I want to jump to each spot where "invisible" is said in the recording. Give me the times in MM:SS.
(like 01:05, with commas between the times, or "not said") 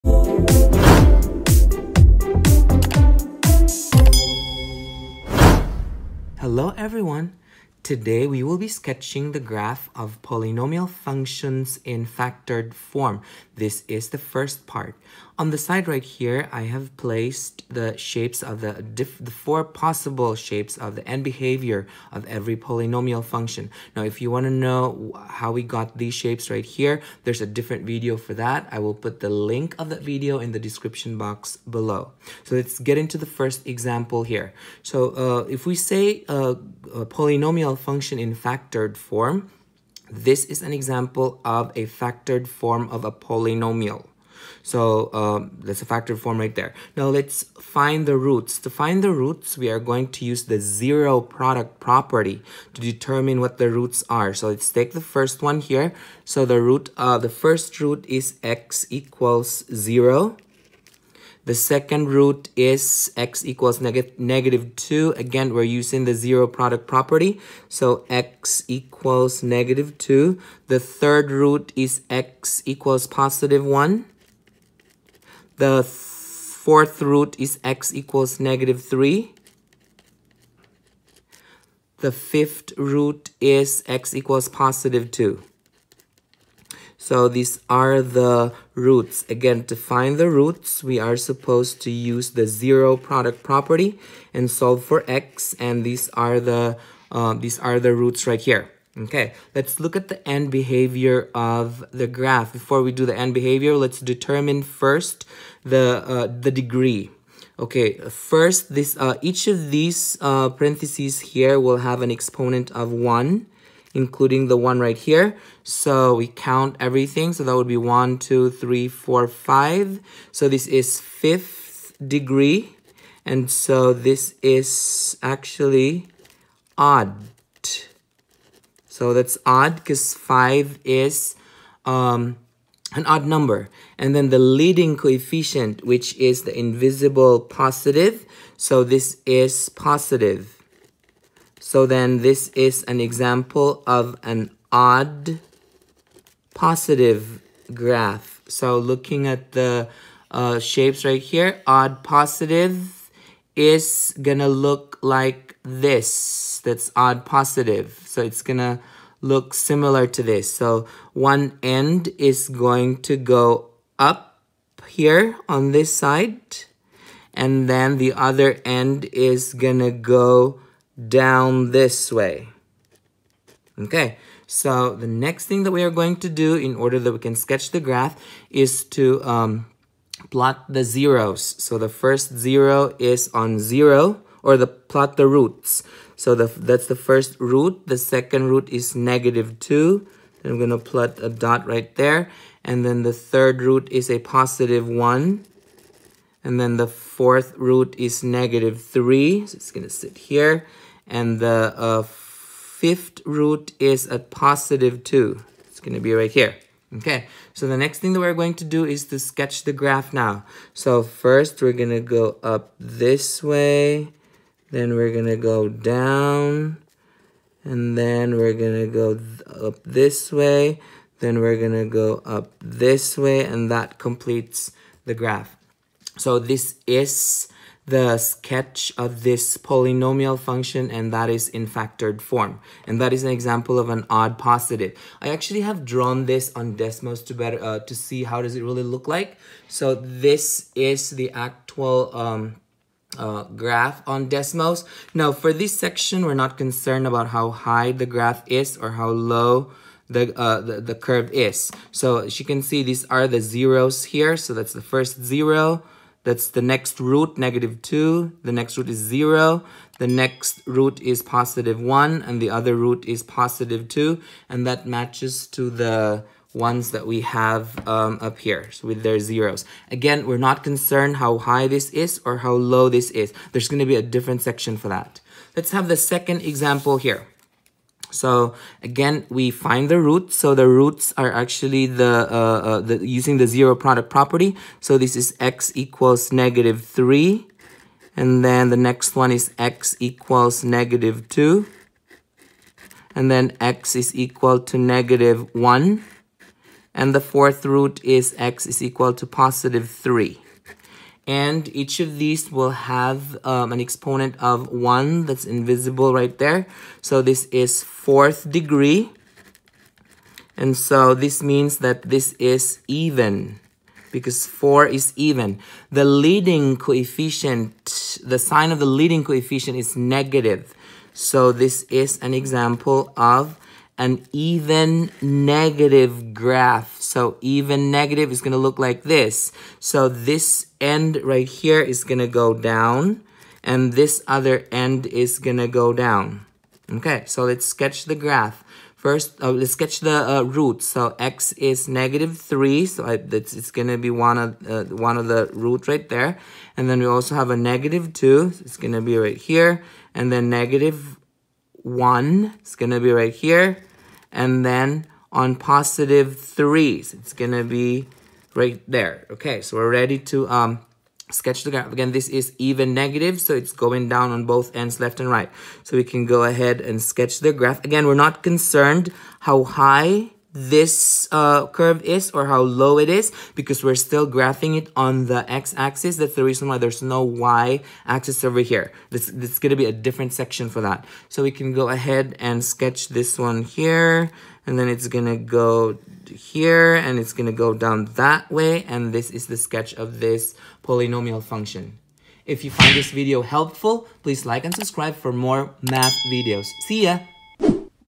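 02:16, 05:05.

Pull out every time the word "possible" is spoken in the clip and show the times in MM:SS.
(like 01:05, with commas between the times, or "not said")
00:19.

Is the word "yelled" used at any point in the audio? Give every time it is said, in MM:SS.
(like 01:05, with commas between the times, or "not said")
not said.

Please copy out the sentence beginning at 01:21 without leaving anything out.
The fifth root is x equals positive 2.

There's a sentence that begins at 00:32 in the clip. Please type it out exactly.
So let's get into the first example here.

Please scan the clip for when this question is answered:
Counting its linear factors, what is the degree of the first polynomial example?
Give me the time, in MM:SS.
02:00.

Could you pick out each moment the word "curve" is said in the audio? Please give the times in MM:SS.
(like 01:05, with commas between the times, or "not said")
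04:10, 06:11.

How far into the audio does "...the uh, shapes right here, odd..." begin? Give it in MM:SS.
02:29.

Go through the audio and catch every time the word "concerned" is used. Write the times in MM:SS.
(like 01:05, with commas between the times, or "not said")
04:06, 04:30, 06:08.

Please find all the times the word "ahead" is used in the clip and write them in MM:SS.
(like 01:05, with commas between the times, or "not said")
06:06, 06:21.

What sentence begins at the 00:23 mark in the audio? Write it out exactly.
Now, if you want to know how we got these shapes right here, there's a different video for that.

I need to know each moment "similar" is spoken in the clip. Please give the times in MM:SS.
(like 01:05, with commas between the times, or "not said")
02:39.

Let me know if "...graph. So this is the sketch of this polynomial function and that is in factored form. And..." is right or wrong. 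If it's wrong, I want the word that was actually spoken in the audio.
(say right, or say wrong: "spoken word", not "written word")
right.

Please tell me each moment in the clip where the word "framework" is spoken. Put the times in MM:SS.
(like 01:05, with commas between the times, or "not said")
not said.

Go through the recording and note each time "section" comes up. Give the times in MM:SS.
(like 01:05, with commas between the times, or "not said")
04:05, 04:34, 06:20.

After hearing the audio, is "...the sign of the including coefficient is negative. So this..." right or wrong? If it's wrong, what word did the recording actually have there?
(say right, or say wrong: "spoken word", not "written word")
wrong: "leading", not "including".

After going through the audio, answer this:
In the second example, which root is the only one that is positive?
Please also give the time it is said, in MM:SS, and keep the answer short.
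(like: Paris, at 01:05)
3, at 04:59.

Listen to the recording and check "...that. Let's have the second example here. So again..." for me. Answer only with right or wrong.
right.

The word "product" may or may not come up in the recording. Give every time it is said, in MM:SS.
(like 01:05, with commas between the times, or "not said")
00:51, 01:06, 01:32, 04:43.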